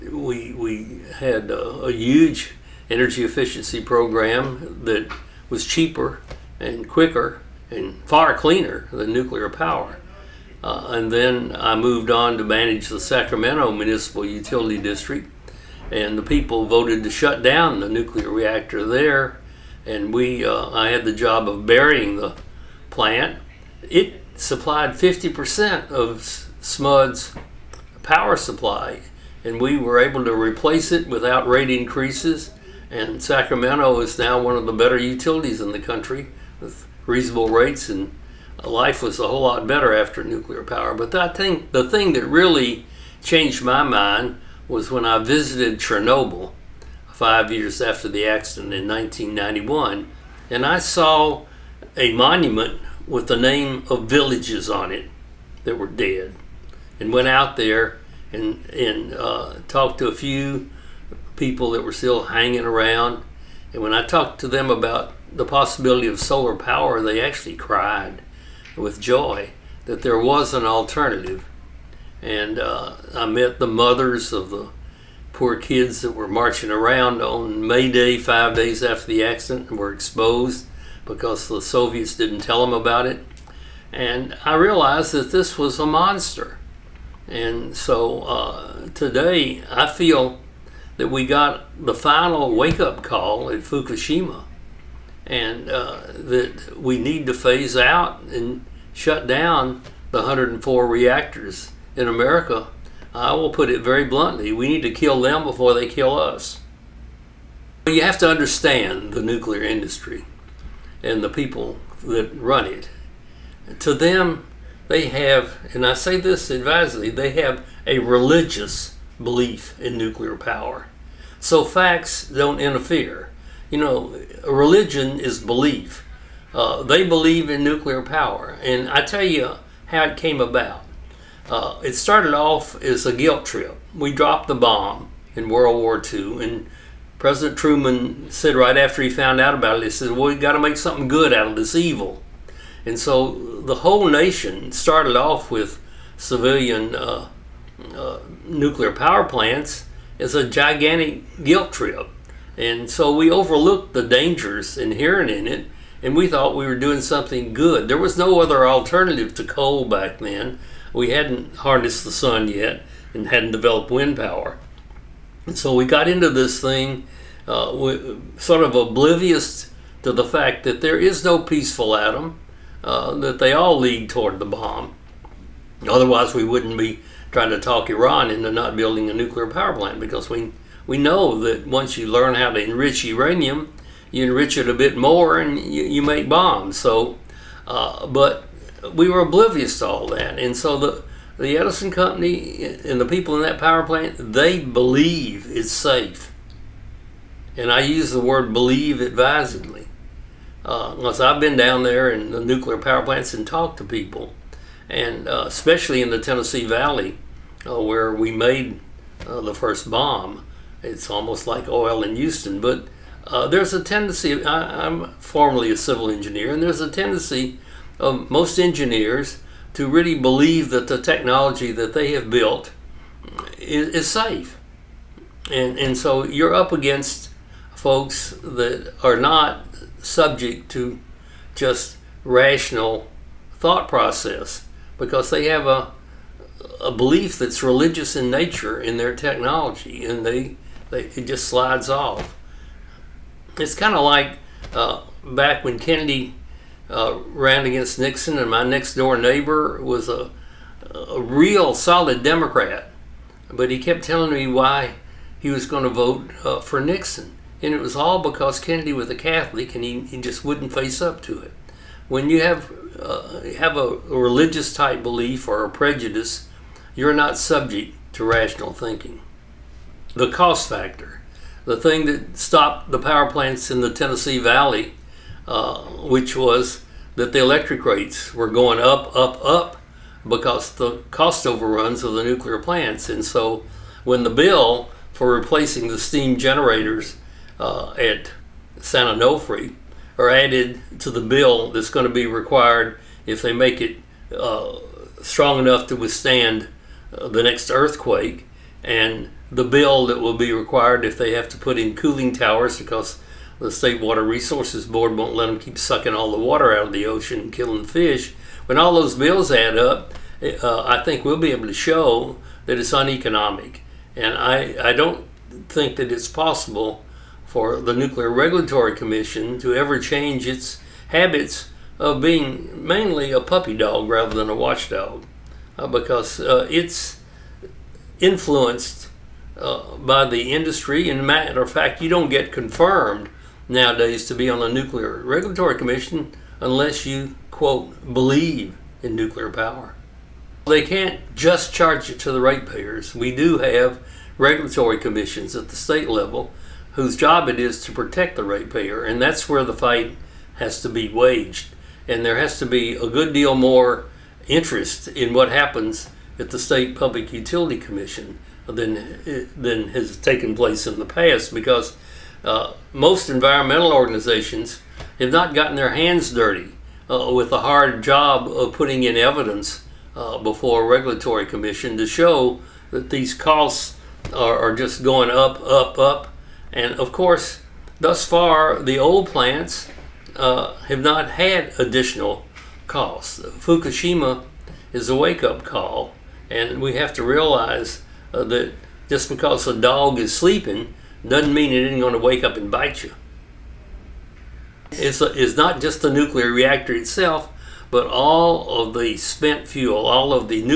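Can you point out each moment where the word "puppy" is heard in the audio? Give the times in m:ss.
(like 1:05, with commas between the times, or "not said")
5:23.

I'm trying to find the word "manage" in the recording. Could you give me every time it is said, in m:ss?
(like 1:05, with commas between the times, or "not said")
0:12.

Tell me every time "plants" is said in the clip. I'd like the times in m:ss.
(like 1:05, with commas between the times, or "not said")
0:22, 2:29, 2:59, 3:13, 3:23, 4:33, 4:42, 6:19.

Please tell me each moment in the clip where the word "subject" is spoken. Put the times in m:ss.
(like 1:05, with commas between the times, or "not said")
3:49, 4:27.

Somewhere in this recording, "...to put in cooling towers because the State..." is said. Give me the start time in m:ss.
5:01.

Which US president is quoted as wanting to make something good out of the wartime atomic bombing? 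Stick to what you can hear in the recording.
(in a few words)
Truman.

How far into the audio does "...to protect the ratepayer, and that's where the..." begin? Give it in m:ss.
5:47.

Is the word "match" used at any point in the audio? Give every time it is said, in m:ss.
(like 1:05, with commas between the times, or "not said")
not said.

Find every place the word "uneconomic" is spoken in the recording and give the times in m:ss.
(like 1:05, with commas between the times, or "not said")
5:12.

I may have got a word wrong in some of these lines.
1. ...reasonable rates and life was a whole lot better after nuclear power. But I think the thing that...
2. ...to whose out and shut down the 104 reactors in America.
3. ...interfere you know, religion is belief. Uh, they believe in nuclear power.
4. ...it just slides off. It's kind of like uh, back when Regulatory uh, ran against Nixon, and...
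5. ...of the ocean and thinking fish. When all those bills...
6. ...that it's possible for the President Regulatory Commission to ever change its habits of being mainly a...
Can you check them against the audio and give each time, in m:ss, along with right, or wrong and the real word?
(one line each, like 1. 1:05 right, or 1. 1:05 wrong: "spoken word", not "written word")
1. 0:37 right
2. 1:37 wrong: "phase", not "whose"
3. 2:02 right
4. 4:00 wrong: "Kennedy", not "Regulatory"
5. 5:06 wrong: "killing", not "thinking"
6. 5:15 wrong: "Nuclear", not "President".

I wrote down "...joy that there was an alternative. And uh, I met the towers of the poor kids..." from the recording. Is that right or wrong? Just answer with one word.
wrong.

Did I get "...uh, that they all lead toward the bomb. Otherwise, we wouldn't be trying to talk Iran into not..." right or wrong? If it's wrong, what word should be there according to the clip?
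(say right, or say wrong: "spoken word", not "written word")
right.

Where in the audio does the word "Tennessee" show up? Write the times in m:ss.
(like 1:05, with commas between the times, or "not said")
3:26, 4:33.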